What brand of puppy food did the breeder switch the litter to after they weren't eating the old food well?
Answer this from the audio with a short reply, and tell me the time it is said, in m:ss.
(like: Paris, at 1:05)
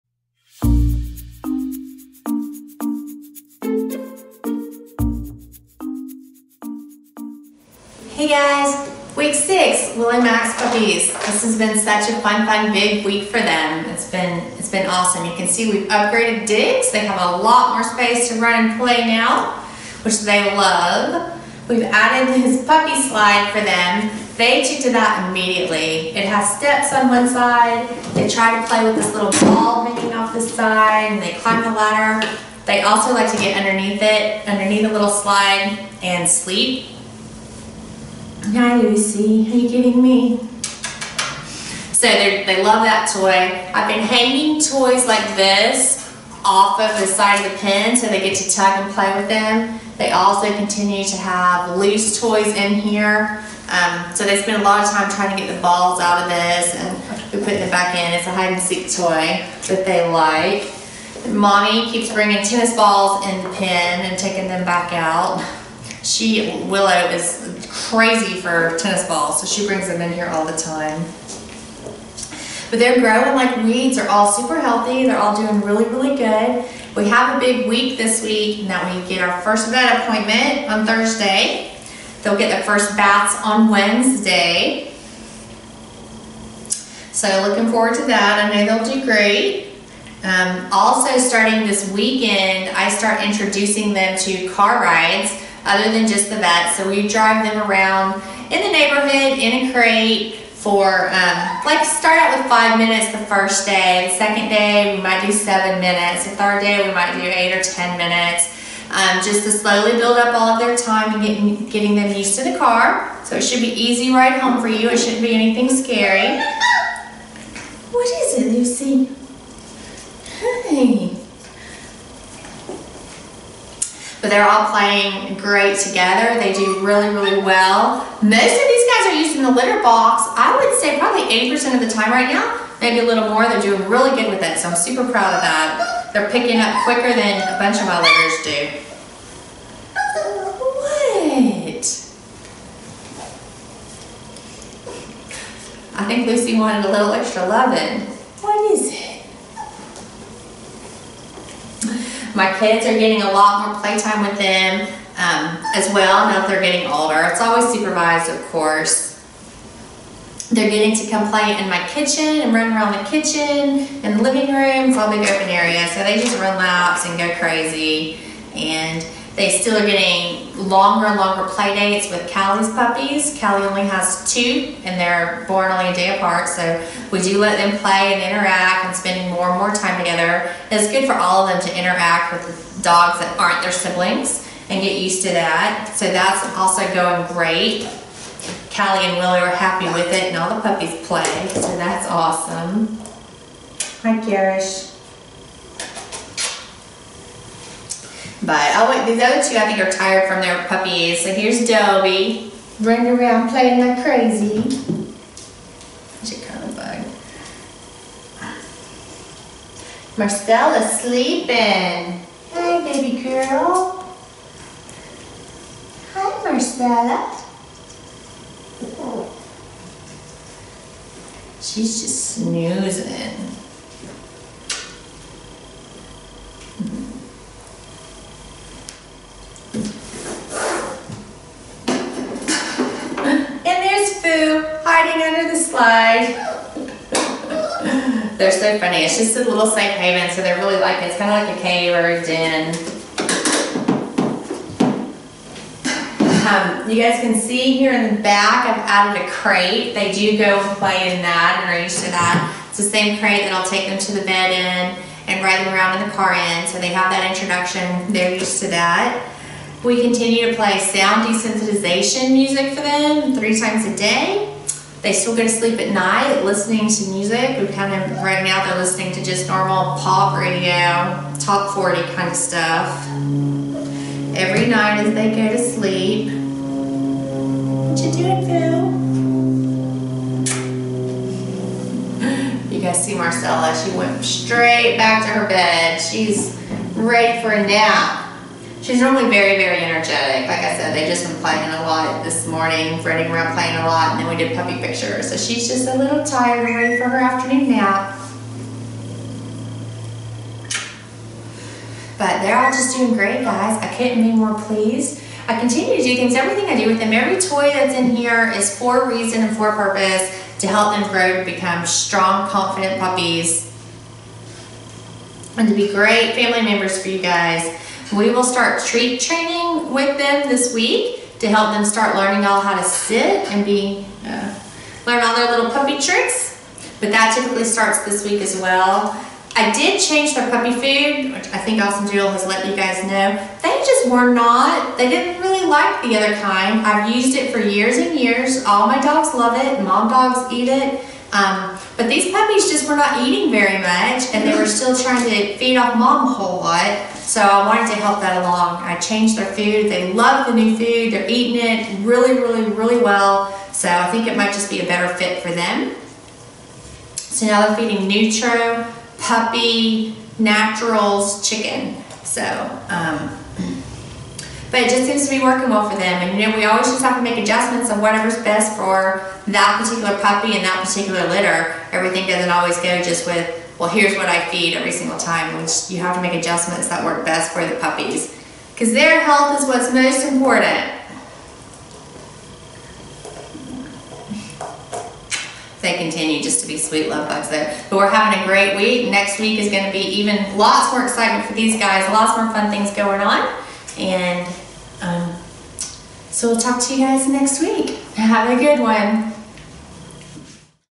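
Nutro, at 5:58.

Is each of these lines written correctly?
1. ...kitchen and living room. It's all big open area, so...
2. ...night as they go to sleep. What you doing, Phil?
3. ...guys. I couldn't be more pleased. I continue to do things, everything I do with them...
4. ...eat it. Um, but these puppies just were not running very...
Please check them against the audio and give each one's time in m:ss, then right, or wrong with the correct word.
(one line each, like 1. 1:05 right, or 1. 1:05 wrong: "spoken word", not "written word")
1. 2:43 right
2. 4:34 right
3. 5:03 right
4. 5:40 wrong: "eating", not "running".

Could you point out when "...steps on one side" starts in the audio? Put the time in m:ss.
0:26.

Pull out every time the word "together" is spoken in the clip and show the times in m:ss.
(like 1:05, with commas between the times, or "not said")
2:05, 2:59.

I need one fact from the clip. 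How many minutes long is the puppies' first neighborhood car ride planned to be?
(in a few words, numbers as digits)
5.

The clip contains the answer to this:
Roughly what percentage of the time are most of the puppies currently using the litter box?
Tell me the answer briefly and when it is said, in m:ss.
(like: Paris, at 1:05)
80%, at 2:11.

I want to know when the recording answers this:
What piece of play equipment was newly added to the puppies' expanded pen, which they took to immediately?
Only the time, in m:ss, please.
0:22.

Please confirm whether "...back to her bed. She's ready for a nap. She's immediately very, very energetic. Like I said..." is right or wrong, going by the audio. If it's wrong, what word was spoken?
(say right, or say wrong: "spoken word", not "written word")
wrong: "normally", not "immediately".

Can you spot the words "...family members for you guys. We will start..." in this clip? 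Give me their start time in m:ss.
5:16.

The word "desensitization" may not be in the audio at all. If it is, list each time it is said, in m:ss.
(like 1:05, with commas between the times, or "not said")
4:21.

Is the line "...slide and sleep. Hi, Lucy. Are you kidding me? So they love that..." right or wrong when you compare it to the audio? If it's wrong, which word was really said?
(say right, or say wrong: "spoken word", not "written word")
right.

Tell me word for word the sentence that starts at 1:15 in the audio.
They're all doing really, really good.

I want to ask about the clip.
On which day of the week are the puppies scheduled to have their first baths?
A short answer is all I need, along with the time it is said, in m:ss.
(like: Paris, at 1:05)
Wednesday, at 1:23.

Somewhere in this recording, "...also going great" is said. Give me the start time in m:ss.
3:06.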